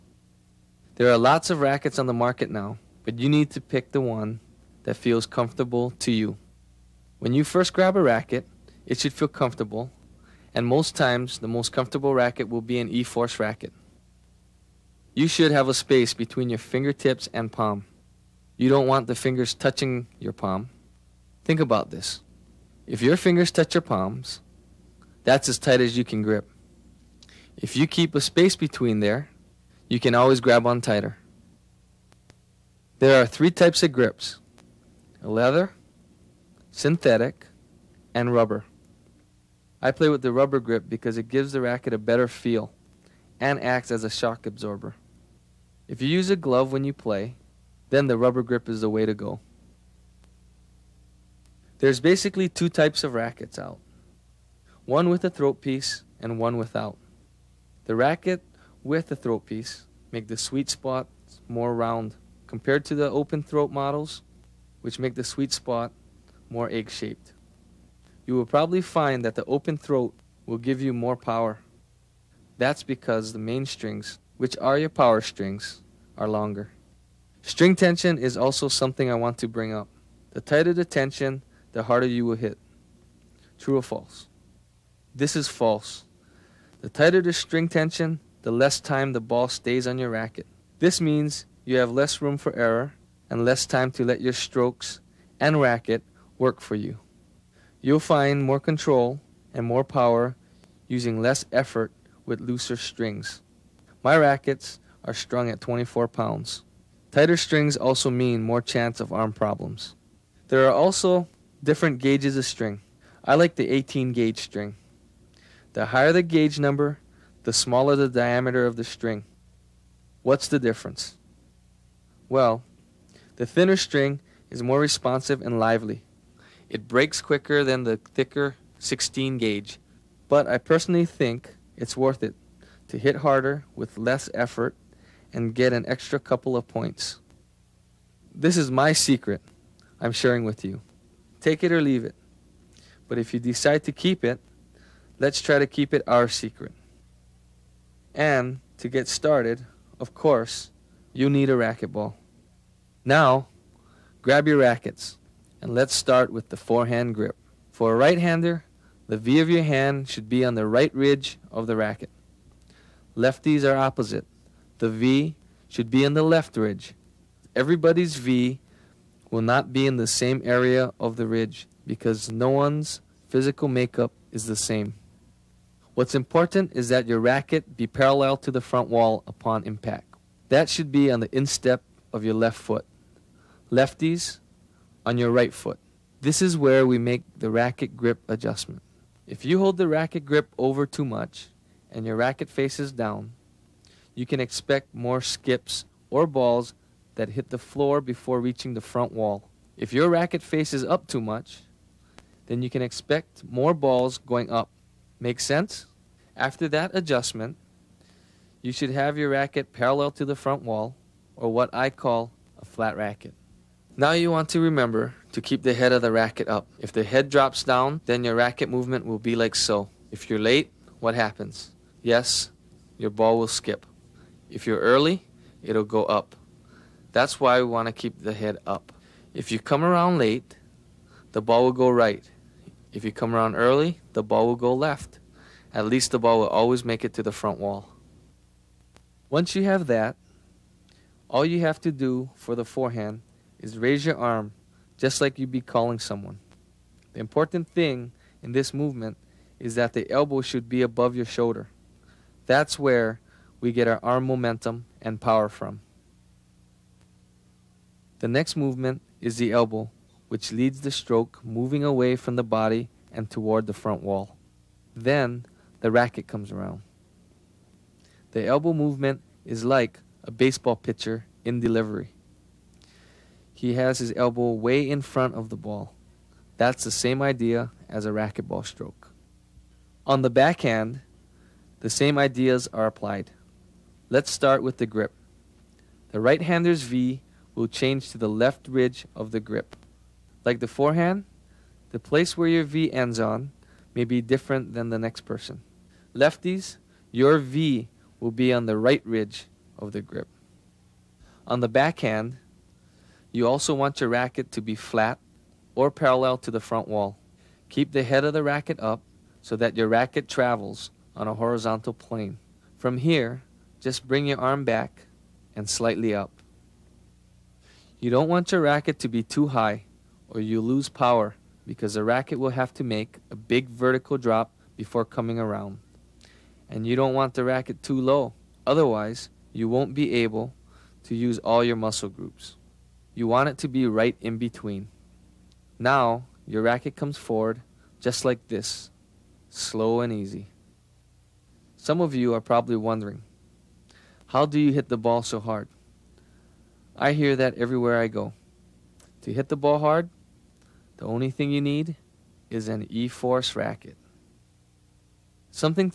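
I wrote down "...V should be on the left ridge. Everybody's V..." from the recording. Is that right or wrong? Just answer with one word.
right.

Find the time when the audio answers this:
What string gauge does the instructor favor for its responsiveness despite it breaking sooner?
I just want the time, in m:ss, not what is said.
1:53.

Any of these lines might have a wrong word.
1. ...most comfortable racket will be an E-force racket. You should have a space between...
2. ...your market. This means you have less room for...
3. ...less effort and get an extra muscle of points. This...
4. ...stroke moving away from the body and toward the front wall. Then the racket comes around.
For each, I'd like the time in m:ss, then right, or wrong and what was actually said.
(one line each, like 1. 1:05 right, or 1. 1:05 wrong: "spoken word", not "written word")
1. 0:11 right
2. 1:29 wrong: "racket", not "market"
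3. 2:13 wrong: "couple", not "muscle"
4. 4:20 right.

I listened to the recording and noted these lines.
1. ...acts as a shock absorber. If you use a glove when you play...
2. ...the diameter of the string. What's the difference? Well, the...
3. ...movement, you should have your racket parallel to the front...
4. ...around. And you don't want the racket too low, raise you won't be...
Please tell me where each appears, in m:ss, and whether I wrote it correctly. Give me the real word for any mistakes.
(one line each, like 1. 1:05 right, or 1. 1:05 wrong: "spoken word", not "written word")
1. 0:43 right
2. 1:57 right
3. 3:26 wrong: "adjustment", not "movement"
4. 5:25 wrong: "otherwise", not "raise".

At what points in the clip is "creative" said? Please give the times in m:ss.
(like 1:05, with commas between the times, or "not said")
not said.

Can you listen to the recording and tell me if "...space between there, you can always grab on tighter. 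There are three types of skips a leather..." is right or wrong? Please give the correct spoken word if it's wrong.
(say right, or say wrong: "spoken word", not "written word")
wrong: "grips", not "skips".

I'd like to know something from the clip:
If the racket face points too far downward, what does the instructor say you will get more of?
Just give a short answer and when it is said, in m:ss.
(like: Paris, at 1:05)
skips, at 3:15.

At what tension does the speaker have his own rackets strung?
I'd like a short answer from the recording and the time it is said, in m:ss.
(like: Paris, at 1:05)
24 pounds, at 1:45.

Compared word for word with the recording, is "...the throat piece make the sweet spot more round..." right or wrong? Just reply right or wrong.
right.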